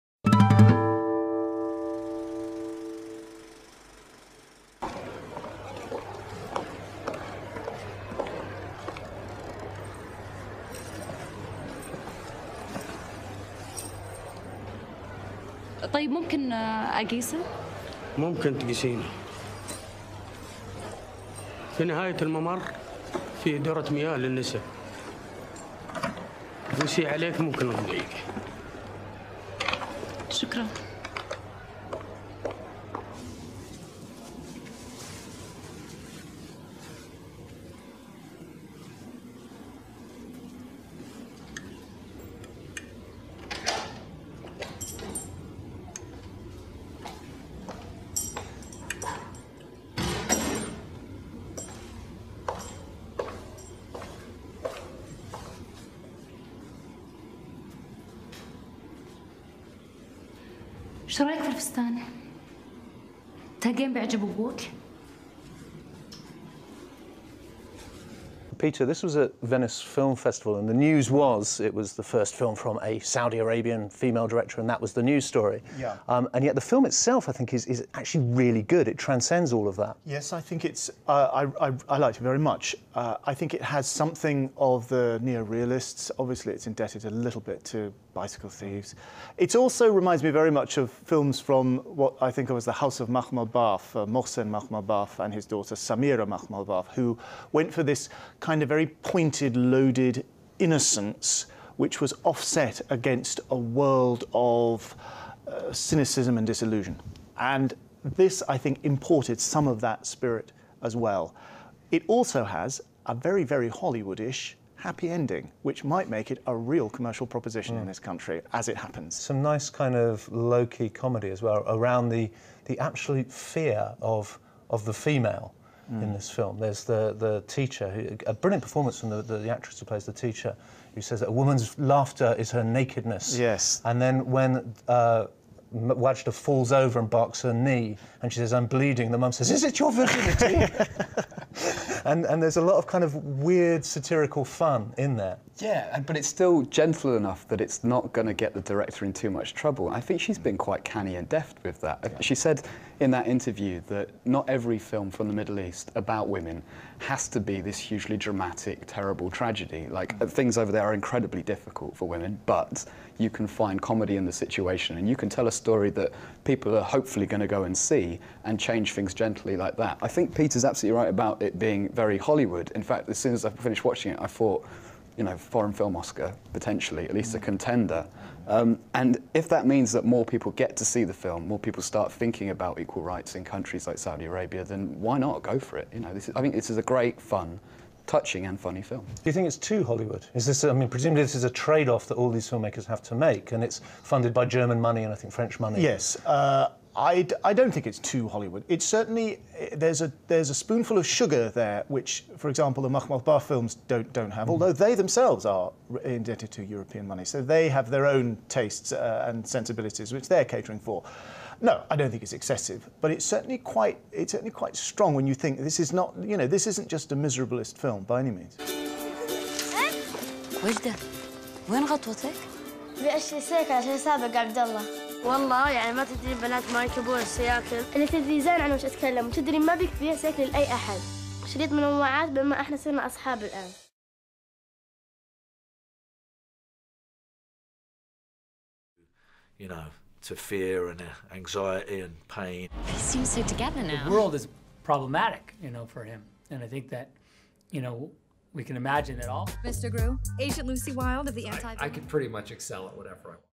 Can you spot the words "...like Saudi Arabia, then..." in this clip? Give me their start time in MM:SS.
03:03.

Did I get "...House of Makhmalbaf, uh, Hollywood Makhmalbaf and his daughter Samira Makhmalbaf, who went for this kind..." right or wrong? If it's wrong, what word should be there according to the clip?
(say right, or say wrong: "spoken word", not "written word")
wrong: "Mohsen", not "Hollywood".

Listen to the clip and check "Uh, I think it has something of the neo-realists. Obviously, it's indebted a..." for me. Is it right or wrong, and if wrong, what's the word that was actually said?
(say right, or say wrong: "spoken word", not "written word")
right.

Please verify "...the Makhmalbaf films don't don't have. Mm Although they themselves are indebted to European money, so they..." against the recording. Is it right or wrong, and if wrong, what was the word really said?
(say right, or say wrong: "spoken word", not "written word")
right.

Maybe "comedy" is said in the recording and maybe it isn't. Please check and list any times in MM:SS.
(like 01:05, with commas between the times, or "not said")
02:00, 02:43.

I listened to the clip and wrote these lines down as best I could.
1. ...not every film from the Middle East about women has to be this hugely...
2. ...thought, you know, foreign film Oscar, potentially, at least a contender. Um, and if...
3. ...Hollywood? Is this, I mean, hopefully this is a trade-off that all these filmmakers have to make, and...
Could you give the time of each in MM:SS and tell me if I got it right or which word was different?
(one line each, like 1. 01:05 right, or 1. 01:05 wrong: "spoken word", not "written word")
1. 02:34 right
2. 02:54 right
3. 03:09 wrong: "presumably", not "hopefully".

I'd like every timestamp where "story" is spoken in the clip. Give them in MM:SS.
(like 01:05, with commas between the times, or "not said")
01:15, 02:45.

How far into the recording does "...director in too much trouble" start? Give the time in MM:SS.
02:28.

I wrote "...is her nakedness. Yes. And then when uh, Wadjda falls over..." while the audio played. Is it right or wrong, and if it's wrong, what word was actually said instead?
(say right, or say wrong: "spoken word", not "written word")
right.